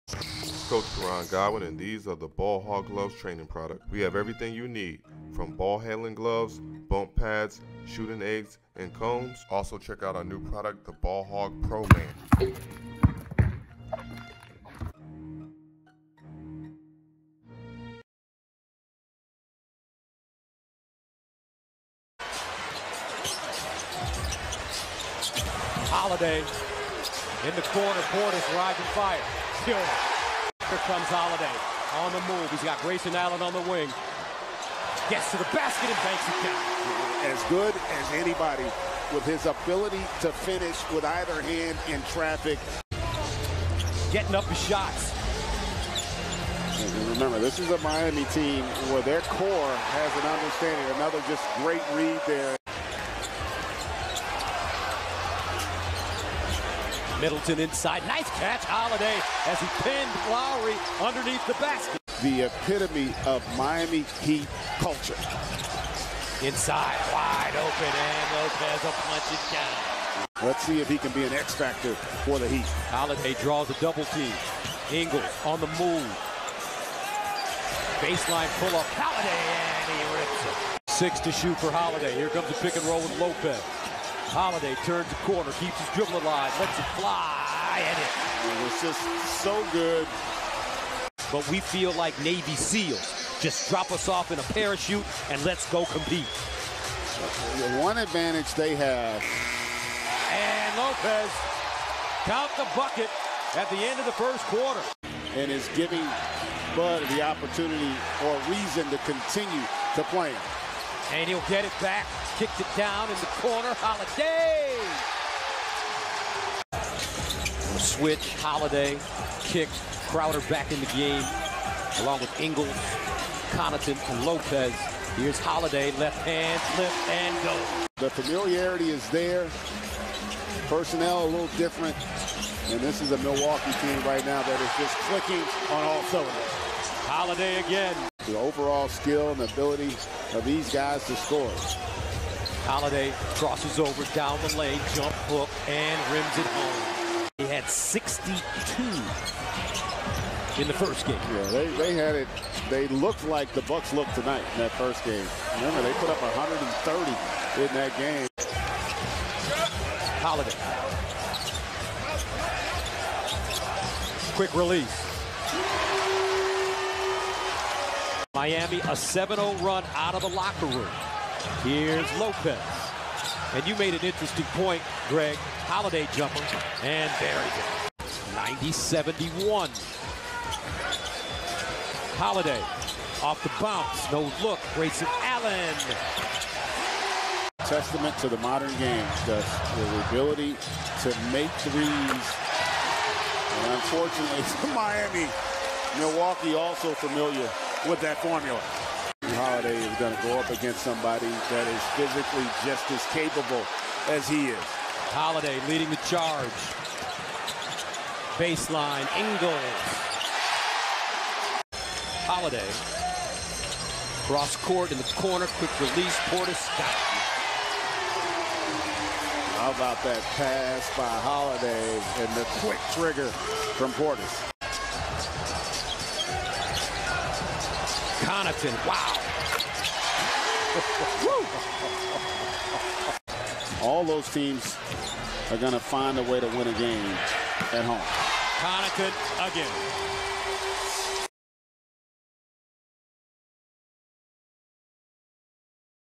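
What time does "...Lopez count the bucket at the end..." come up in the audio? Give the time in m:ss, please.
1:40.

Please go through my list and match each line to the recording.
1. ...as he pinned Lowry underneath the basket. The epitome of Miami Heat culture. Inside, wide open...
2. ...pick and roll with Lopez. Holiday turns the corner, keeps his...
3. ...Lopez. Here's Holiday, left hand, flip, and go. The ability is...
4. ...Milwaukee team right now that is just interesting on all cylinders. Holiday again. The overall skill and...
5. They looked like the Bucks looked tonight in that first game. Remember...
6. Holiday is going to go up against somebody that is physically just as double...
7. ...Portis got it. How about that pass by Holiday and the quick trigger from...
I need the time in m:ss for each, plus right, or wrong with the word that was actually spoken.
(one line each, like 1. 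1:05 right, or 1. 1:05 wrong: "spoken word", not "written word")
1. 0:59 right
2. 1:22 right
3. 2:04 wrong: "familiarity", not "ability"
4. 2:13 wrong: "clicking", not "interesting"
5. 2:32 right
6. 3:19 wrong: "capable", not "double"
7. 3:36 right.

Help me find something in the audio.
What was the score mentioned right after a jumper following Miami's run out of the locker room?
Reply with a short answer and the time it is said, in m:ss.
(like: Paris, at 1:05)
90-71, at 2:58.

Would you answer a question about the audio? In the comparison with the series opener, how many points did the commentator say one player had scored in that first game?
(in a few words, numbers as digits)
62.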